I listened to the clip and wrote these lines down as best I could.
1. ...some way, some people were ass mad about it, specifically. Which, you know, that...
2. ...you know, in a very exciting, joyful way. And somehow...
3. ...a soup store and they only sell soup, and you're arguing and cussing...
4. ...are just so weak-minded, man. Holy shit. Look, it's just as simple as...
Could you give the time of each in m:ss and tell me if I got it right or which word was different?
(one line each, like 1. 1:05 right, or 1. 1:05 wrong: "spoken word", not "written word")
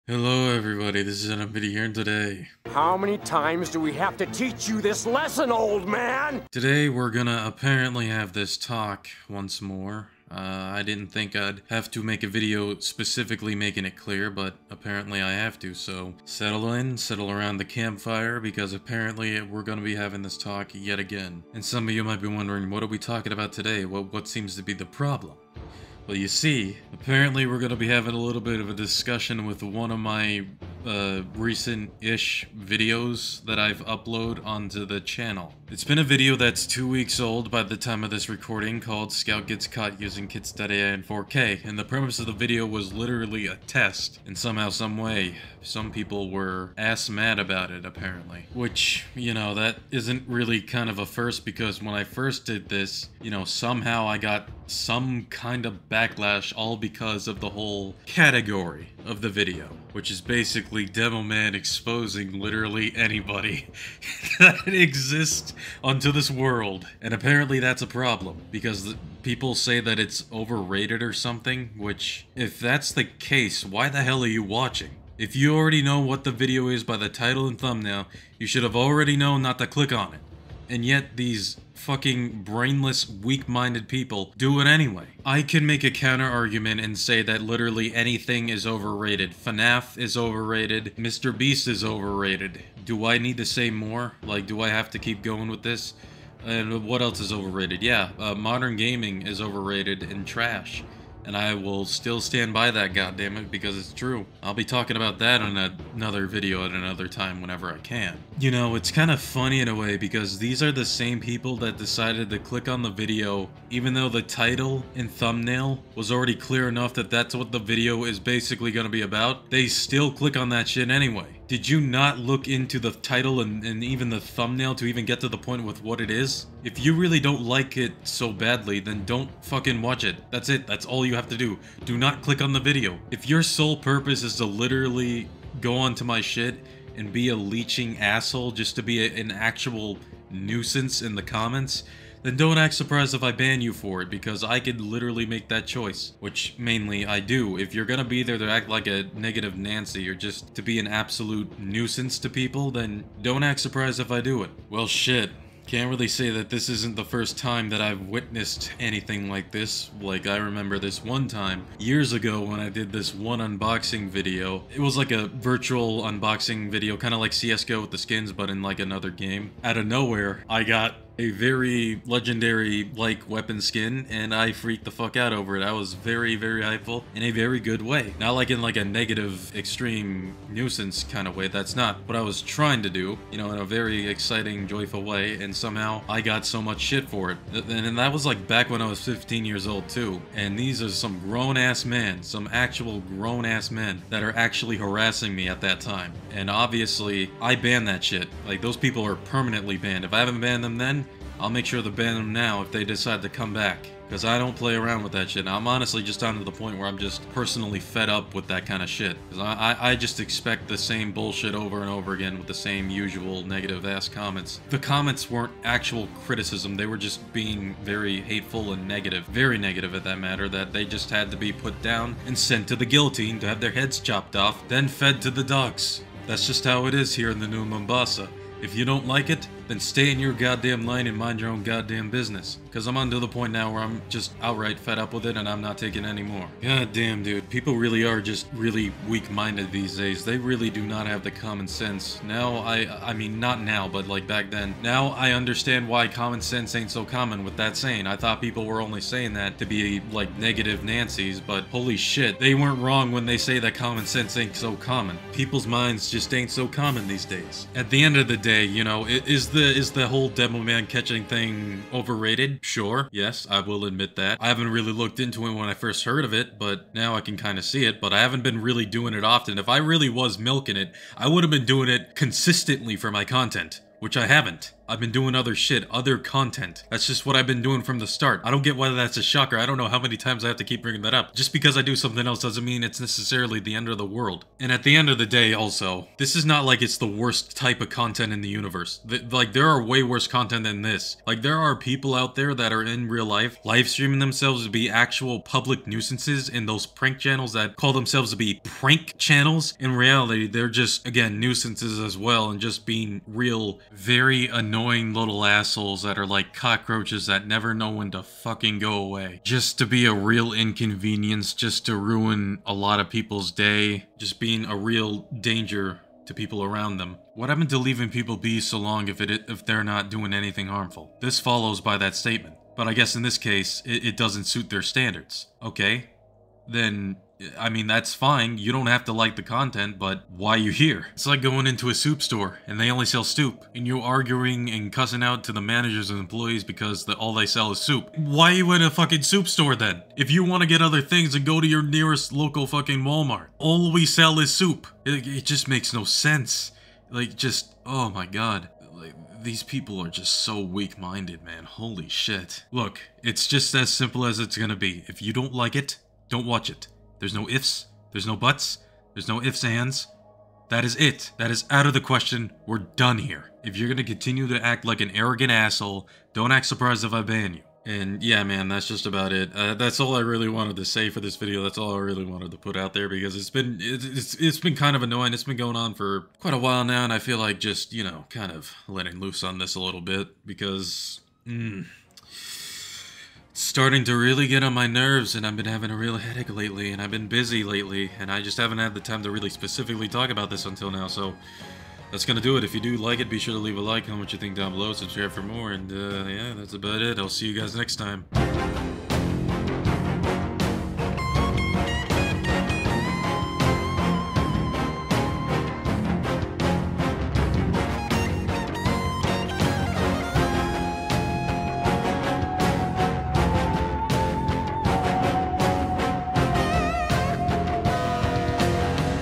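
1. 0:44 wrong: "apparently", not "specifically"
2. 3:03 right
3. 5:31 right
4. 5:50 right.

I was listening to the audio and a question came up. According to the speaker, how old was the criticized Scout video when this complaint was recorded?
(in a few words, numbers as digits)
two weeks.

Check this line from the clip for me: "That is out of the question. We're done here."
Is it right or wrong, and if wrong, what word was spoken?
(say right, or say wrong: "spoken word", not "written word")
right.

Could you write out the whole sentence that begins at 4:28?
But I haven't been really doing it often.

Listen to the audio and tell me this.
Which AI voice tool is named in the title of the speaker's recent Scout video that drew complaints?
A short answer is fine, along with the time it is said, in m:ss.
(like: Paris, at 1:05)
Kits.ai, at 0:40.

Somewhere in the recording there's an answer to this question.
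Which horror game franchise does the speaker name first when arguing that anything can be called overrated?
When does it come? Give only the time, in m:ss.
1:29.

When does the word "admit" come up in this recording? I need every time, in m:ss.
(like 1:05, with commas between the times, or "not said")
4:23.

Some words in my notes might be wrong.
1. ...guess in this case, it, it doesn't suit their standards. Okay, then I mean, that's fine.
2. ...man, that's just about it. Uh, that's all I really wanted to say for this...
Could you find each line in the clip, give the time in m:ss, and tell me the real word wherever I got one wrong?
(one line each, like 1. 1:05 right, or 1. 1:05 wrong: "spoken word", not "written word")
1. 5:22 right
2. 6:08 right.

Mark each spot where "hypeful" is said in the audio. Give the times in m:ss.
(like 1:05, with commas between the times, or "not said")
2:56.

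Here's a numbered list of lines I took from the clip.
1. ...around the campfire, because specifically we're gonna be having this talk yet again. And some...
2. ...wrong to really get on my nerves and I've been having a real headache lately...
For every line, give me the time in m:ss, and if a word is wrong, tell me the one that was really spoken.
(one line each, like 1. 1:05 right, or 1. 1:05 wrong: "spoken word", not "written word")
1. 0:17 wrong: "apparently", not "specifically"
2. 6:23 wrong: "starting", not "wrong".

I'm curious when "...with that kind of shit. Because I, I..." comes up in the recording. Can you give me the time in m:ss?
3:28.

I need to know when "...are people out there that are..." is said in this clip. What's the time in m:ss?
4:51.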